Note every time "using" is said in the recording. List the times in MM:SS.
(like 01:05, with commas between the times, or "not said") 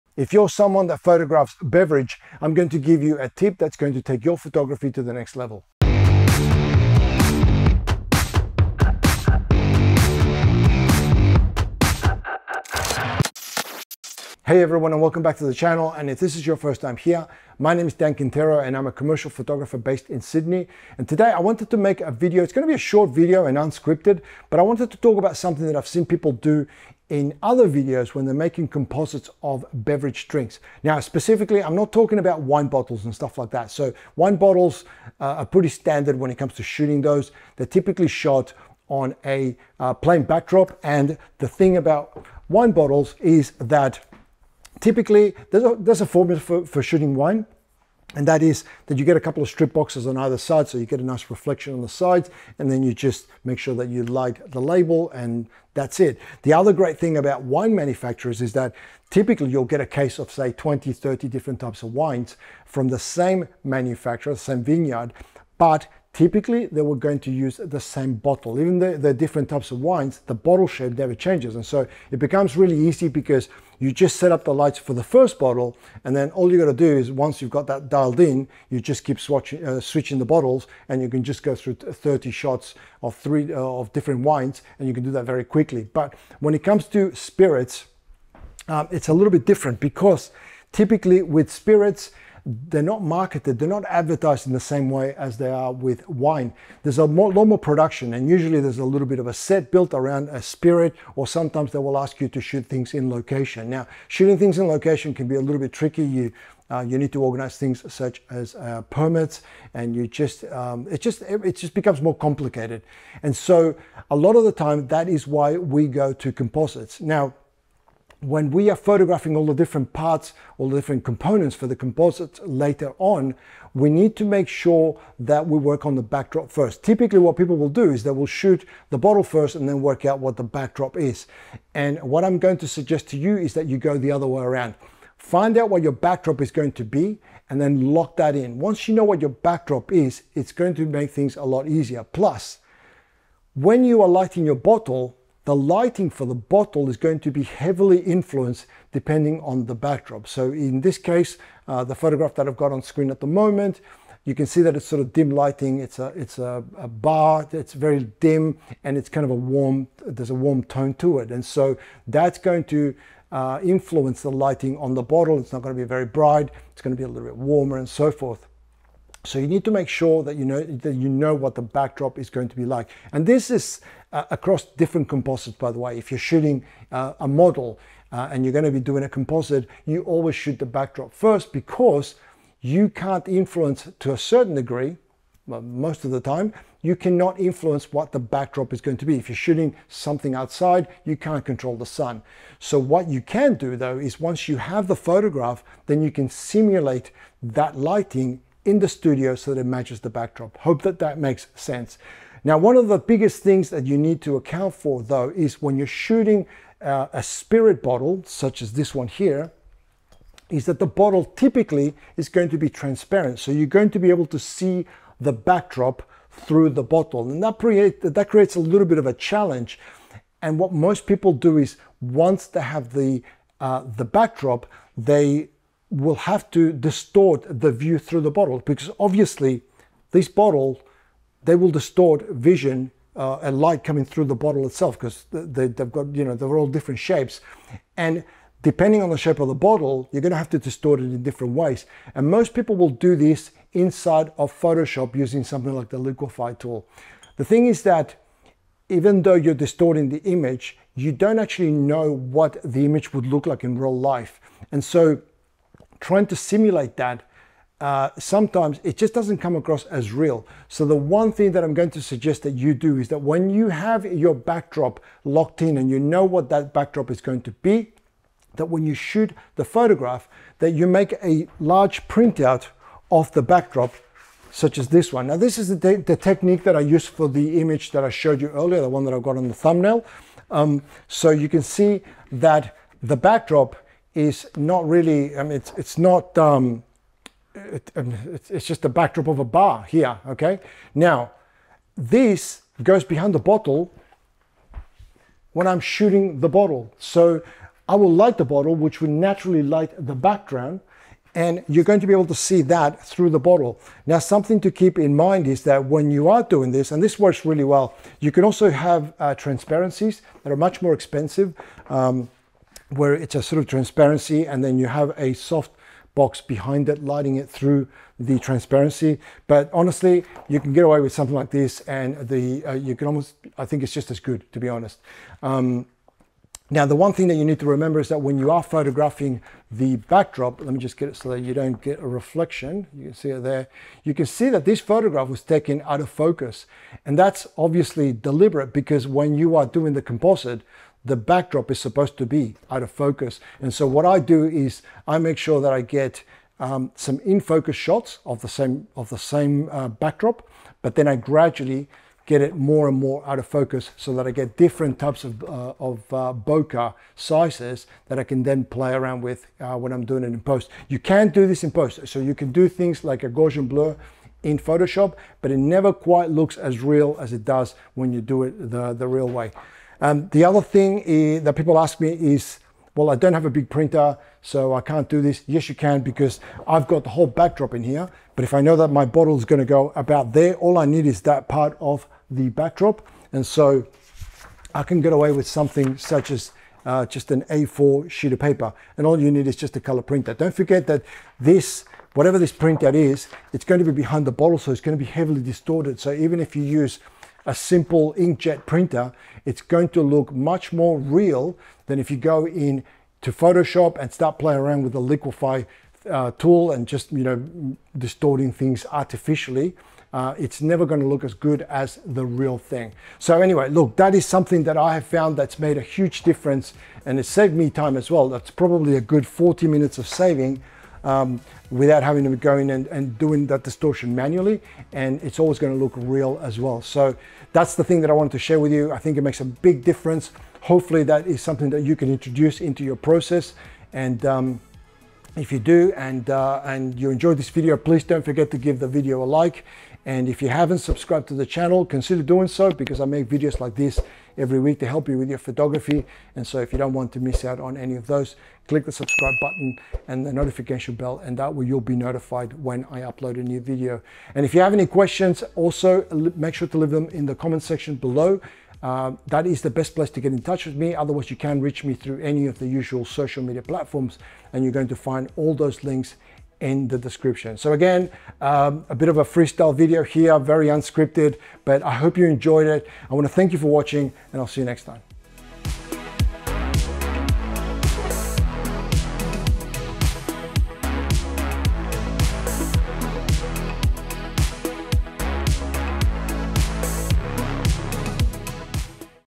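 04:05.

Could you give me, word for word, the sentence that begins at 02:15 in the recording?
Find out what your backdrop is going to be and then lock that in.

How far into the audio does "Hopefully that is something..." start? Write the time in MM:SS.
07:10.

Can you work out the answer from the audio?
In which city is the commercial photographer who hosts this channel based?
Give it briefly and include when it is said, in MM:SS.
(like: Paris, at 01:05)
Sydney, at 00:20.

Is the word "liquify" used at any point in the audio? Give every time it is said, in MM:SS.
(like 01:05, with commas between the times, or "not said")
04:05, 06:45.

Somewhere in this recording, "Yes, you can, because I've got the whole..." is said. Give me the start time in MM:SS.
06:15.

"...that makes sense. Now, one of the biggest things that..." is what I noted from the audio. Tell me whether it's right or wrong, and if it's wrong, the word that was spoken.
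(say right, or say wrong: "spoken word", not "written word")
right.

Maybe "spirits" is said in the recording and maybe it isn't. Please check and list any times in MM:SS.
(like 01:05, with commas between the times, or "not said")
01:27, 01:31, 01:40, 03:27.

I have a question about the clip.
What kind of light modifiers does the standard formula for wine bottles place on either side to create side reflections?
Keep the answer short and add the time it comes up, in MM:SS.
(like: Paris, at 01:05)
strip boxes, at 00:49.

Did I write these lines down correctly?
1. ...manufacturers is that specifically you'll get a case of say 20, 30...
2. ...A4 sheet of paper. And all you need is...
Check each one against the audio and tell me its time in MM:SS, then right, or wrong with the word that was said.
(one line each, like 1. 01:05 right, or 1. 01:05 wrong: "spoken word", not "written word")
1. 00:57 wrong: "typically", not "specifically"
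2. 06:27 right.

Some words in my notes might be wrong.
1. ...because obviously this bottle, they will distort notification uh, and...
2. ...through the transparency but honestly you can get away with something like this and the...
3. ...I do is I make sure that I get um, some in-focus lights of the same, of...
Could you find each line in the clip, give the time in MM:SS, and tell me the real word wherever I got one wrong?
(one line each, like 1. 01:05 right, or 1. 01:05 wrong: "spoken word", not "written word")
1. 03:48 wrong: "vision", not "notification"
2. 05:17 right
3. 05:44 wrong: "shots", not "lights".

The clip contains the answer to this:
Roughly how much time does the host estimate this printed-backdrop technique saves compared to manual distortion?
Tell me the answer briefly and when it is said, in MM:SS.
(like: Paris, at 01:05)
40 minutes, at 06:59.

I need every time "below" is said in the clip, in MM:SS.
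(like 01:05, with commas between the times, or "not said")
07:37.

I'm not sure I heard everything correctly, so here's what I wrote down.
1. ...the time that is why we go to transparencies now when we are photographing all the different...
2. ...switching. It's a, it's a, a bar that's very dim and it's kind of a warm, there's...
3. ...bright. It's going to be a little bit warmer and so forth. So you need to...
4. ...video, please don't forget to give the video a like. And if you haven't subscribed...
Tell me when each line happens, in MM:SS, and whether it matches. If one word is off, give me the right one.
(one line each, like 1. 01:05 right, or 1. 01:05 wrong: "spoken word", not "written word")
1. 01:54 wrong: "composites", not "transparencies"
2. 02:35 wrong: "lighting", not "switching"
3. 02:46 right
4. 07:17 right.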